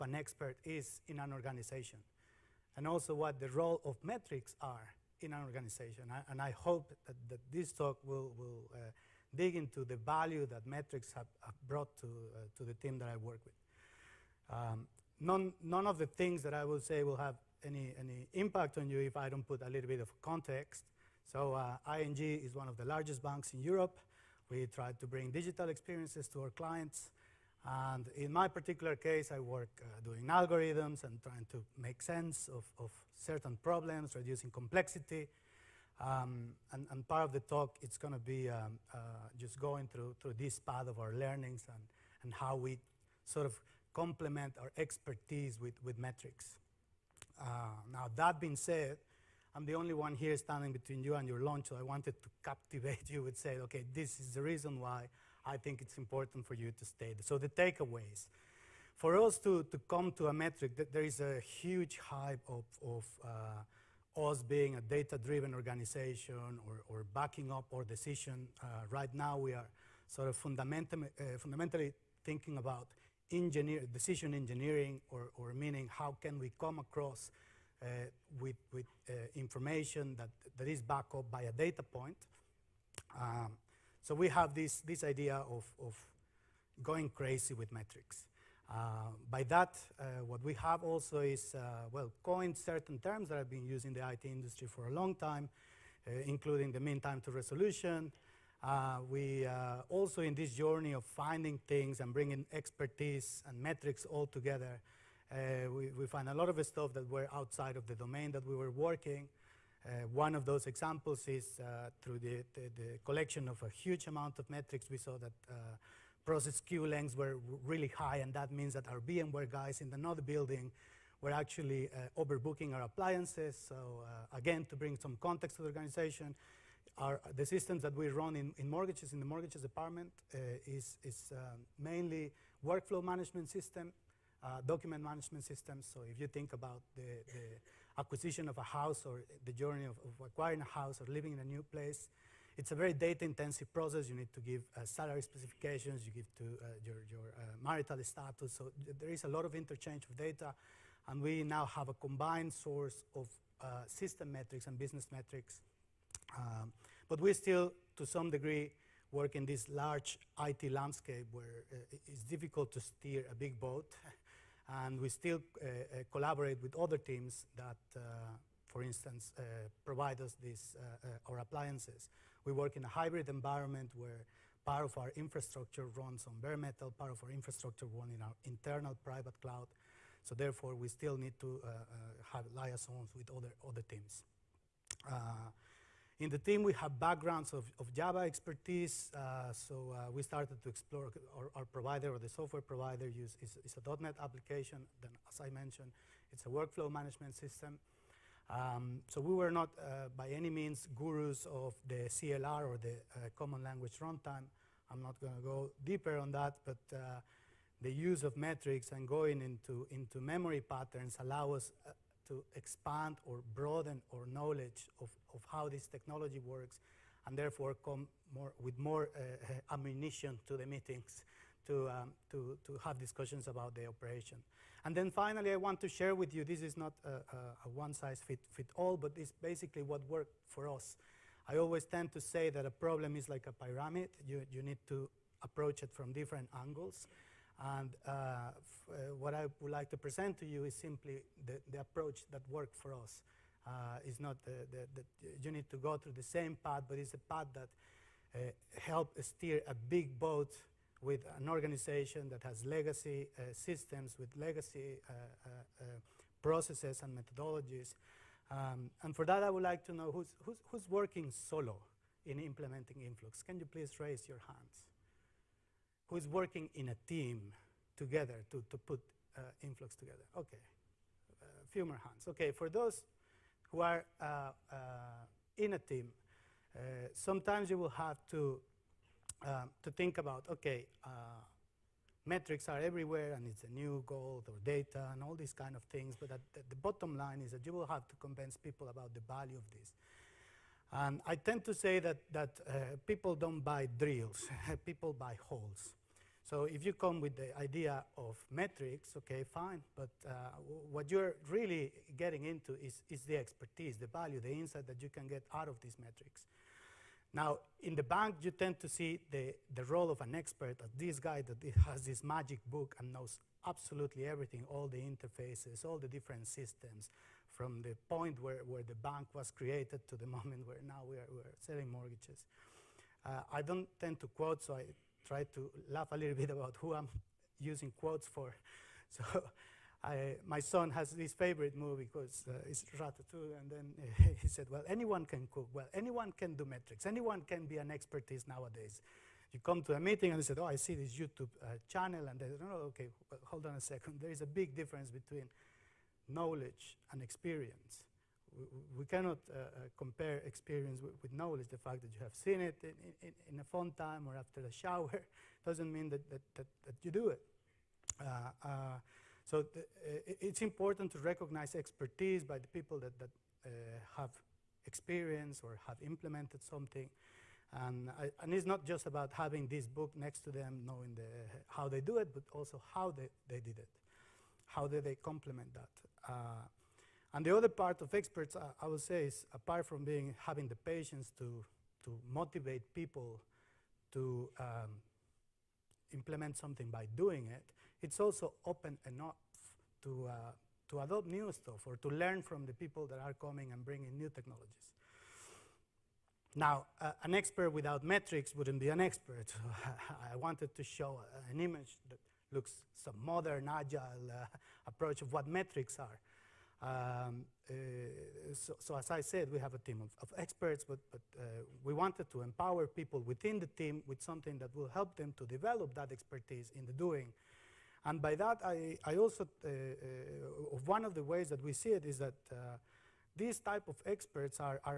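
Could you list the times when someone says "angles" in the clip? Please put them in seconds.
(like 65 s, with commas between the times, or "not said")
236 s.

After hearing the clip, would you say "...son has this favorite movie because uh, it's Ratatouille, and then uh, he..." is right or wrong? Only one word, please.
right.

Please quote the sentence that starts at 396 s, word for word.
Now, uh, an expert without metrics wouldn't be an expert.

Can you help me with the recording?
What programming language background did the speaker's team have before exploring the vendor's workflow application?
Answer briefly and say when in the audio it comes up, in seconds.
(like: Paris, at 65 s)
Java, at 187 s.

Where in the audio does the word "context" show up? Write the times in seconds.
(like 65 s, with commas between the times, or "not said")
20 s, 125 s.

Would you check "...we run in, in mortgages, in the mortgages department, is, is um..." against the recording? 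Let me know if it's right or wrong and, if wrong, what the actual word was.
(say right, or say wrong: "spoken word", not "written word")
right.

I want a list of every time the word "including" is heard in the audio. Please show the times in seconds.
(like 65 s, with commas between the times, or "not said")
96 s.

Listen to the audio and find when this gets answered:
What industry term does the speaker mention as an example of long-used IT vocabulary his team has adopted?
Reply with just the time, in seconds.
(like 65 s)
96 s.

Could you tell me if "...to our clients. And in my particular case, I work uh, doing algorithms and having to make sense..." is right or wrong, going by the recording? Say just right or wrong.
wrong.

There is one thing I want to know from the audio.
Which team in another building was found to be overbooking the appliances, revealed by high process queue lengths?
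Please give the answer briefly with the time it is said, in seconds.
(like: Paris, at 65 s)
VMware guys, at 118 s.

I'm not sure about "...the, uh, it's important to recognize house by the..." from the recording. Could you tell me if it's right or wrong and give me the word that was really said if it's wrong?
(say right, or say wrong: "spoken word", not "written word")
wrong: "expertise", not "house".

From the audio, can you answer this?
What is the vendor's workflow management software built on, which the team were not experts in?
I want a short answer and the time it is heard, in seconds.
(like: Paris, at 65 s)
.NET, at 194 s.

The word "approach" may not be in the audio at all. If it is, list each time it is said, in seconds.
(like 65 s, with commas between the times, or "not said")
235 s, 241 s, 404 s.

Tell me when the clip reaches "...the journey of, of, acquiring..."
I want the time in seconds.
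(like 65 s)
139 s.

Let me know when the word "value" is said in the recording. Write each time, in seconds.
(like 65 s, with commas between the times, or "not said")
9 s, 289 s, 304 s.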